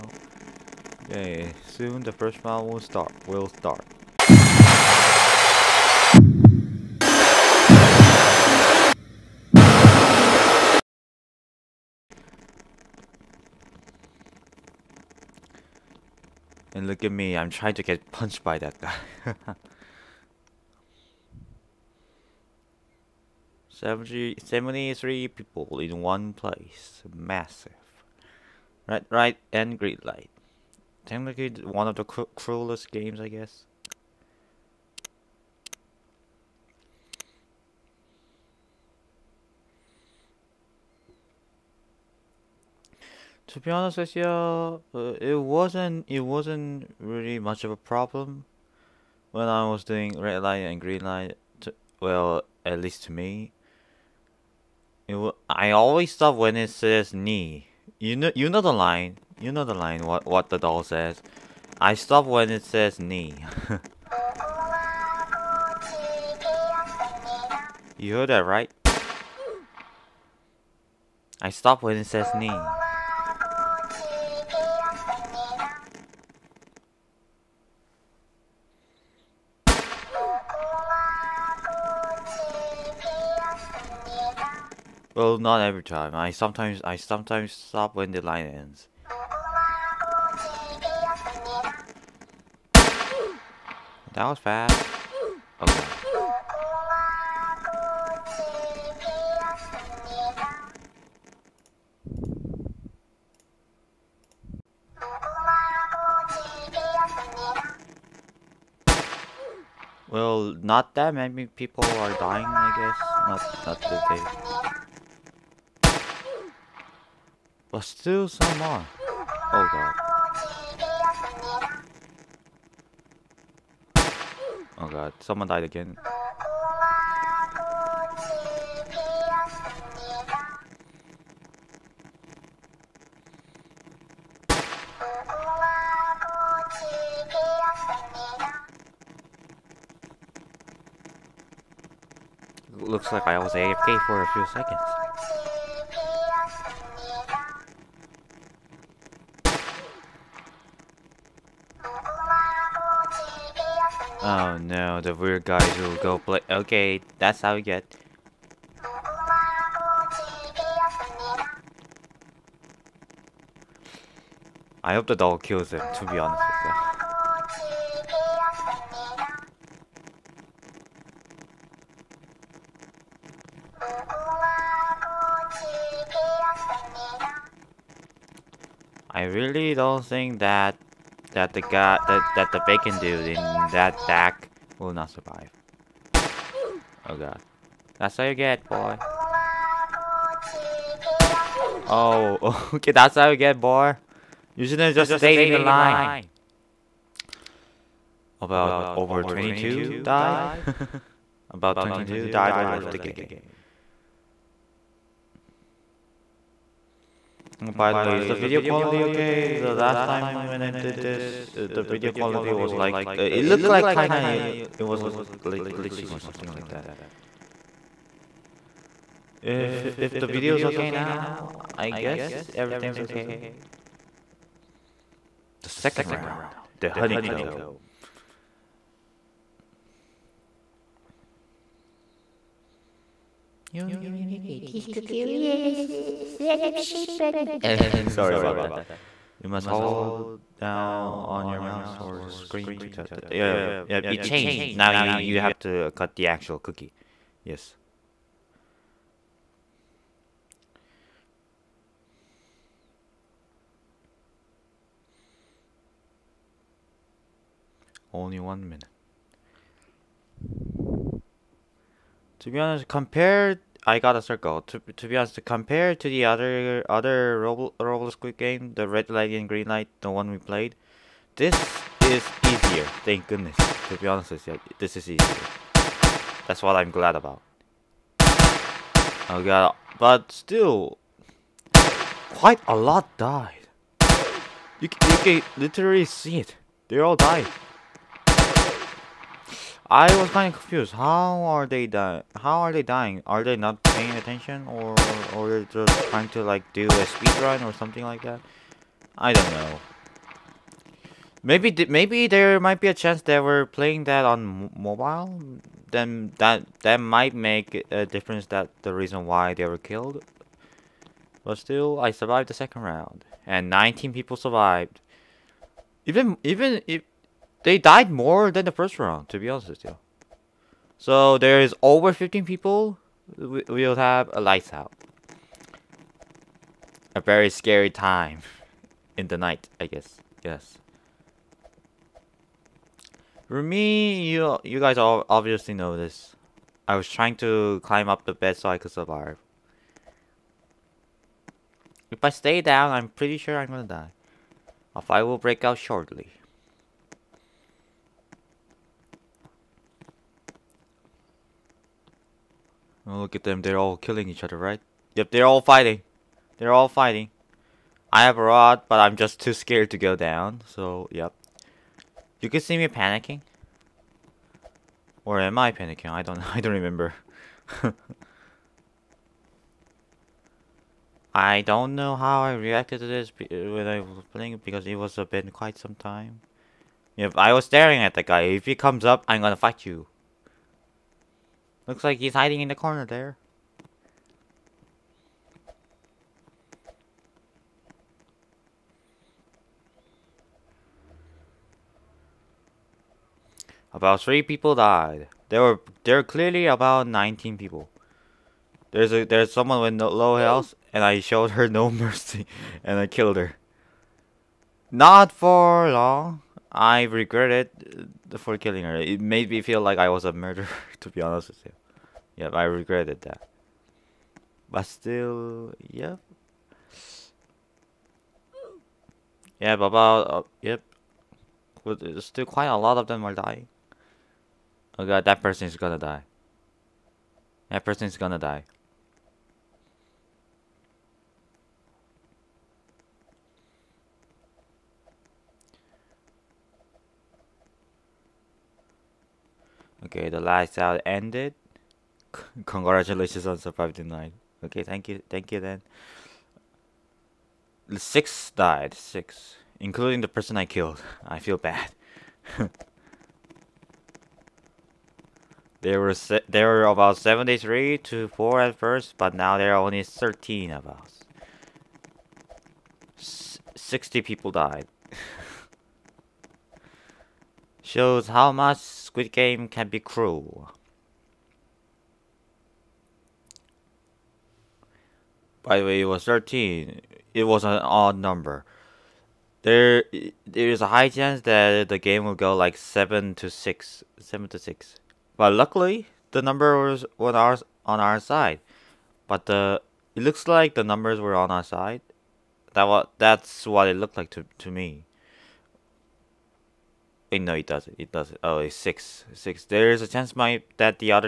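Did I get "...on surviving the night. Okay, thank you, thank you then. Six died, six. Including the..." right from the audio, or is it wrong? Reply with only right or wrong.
right.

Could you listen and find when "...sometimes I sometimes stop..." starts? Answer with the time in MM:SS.
01:26.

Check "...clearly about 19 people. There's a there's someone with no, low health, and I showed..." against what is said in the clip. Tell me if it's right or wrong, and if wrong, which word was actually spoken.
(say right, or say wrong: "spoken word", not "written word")
right.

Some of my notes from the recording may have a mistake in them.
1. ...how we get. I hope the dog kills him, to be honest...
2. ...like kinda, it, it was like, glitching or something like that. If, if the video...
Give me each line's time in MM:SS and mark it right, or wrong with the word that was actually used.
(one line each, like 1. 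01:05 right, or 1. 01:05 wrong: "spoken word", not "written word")
1. 02:37 right
2. 03:33 right.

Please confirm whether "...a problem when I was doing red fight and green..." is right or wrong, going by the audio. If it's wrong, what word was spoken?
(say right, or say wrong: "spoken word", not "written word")
wrong: "light", not "fight".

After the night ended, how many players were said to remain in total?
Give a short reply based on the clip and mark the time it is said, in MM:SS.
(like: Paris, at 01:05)
13, at 07:39.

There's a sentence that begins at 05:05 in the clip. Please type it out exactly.
Then that that might make a difference.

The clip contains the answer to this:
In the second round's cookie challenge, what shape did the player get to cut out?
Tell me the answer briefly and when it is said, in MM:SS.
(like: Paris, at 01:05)
circle, at 04:23.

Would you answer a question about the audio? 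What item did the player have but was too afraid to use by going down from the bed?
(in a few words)
a rod.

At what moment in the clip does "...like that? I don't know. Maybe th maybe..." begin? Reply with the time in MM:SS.
04:58.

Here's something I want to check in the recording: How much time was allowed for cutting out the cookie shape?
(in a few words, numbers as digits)
one minute.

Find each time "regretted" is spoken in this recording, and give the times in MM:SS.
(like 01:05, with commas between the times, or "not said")
06:47, 06:52.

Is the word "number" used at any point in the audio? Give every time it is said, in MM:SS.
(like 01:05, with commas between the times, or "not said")
07:58, 08:06, 08:10.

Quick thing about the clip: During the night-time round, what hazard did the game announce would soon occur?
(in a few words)
A fire.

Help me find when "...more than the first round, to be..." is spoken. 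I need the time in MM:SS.
05:18.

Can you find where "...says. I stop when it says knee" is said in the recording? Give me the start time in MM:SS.
01:00.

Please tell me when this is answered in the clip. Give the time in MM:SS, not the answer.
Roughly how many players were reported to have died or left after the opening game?
03:21.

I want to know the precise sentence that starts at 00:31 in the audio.
Technically one of the cruelest games, I guess.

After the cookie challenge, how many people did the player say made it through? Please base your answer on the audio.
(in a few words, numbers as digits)
19.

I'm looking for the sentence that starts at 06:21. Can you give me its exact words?
Looks like he's hiding in the corner there.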